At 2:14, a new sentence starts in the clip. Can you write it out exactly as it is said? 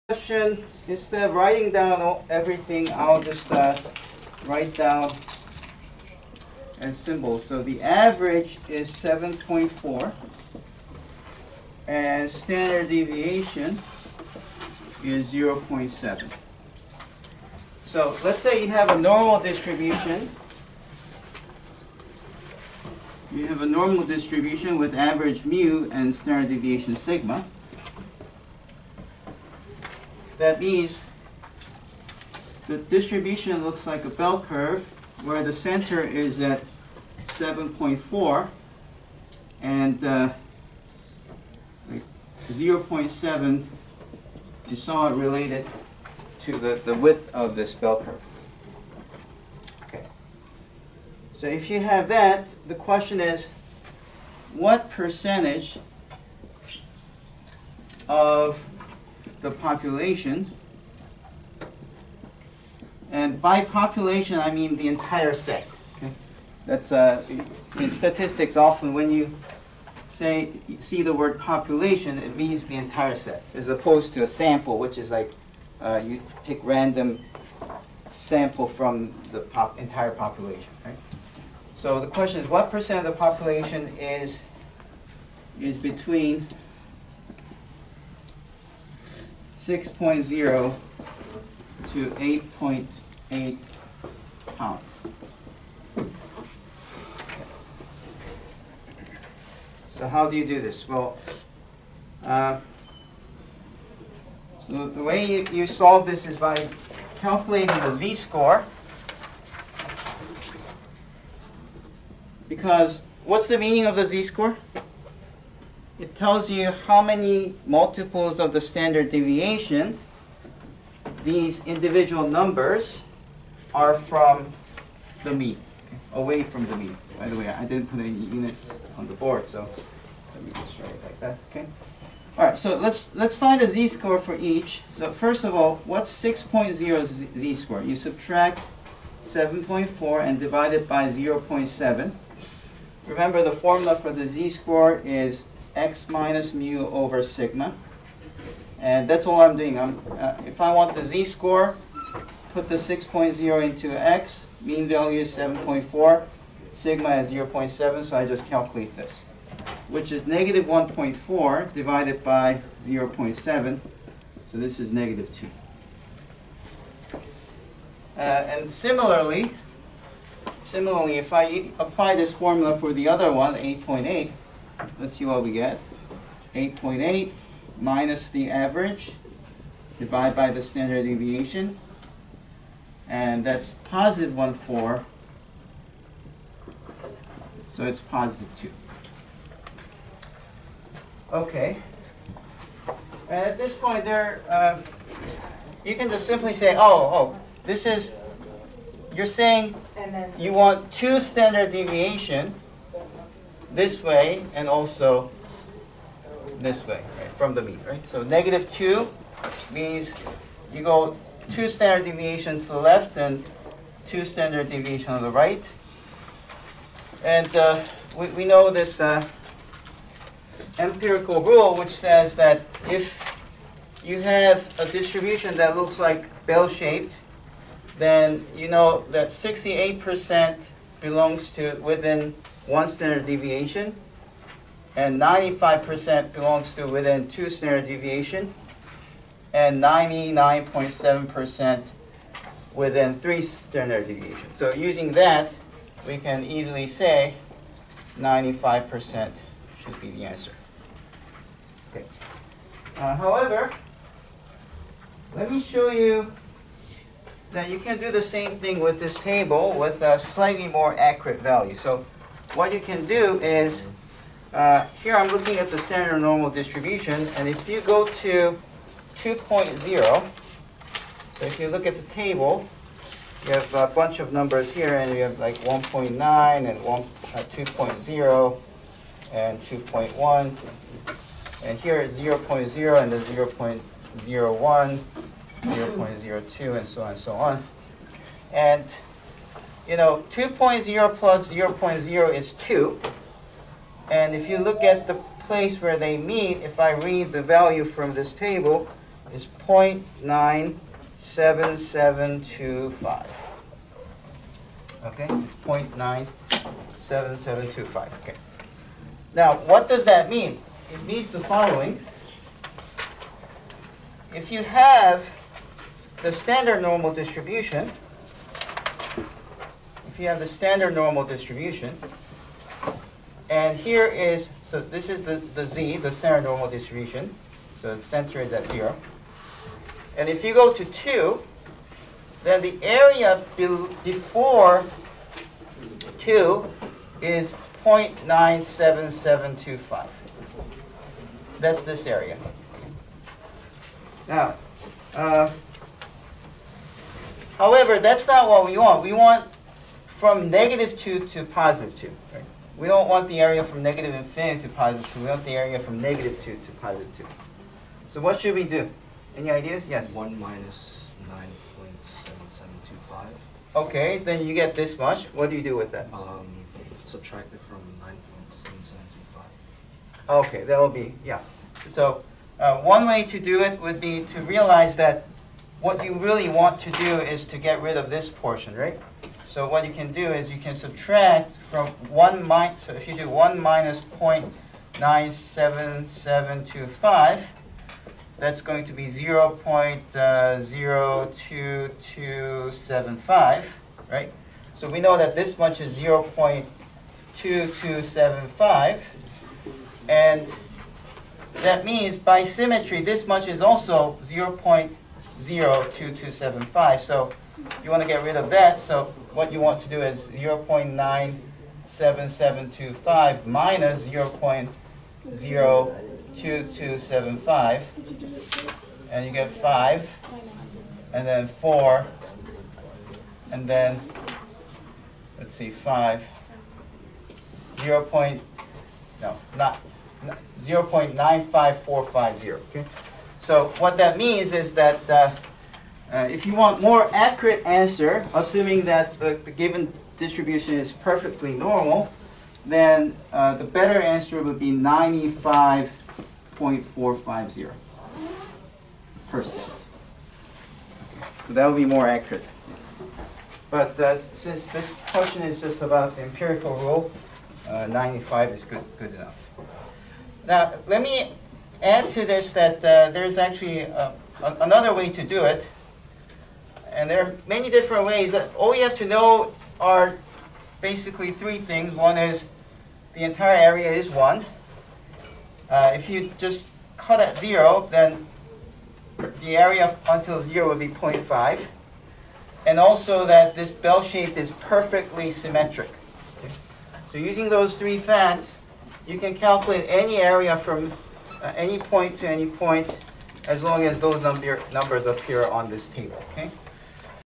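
So first of all, what's 6.0 z-score?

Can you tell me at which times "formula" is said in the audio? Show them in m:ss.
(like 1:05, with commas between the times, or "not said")
2:23, 2:52.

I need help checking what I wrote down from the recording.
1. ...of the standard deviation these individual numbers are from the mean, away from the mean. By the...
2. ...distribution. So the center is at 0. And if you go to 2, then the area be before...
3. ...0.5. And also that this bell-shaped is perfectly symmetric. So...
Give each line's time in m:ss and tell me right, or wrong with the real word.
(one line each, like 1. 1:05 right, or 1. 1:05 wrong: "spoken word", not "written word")
1. 1:58 right
2. 5:26 right
3. 8:00 right.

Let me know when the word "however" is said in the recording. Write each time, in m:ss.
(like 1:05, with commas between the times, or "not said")
4:13, 5:47.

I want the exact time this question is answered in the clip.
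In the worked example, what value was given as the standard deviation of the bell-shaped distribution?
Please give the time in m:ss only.
0:12.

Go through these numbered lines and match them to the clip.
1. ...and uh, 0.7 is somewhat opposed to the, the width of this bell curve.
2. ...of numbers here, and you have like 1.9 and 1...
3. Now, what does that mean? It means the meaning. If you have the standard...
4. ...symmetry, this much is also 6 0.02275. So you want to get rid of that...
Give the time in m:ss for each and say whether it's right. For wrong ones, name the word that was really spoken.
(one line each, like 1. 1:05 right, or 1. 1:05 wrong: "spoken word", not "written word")
1. 0:39 wrong: "related", not "opposed"
2. 4:34 right
3. 5:09 wrong: "following", not "meaning"
4. 6:42 wrong: "0", not "6".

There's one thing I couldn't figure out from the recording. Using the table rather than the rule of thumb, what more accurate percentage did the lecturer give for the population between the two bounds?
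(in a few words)
95.450%.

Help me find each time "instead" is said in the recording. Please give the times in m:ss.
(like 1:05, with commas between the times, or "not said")
0:00.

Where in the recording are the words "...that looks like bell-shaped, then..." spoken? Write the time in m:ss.
3:45.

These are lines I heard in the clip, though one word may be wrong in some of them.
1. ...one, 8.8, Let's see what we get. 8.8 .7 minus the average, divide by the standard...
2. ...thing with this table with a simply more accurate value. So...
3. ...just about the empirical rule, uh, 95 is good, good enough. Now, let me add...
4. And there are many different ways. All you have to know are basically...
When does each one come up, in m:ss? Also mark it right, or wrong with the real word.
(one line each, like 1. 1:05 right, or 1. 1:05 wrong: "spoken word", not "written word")
1. 2:53 wrong: "8", not "7"
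2. 4:18 wrong: "slightly", not "simply"
3. 7:35 right
4. 7:47 right.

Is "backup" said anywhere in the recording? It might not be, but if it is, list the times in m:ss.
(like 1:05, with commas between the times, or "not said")
not said.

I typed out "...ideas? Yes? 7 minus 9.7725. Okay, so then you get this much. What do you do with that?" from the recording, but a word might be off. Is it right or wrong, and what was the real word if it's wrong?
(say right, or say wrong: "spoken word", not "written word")
wrong: "1", not "7".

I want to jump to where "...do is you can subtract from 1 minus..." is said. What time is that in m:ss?
6:20.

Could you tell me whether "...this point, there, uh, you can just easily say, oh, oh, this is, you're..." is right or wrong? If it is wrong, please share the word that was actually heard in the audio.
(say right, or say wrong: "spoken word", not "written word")
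wrong: "simply", not "easily".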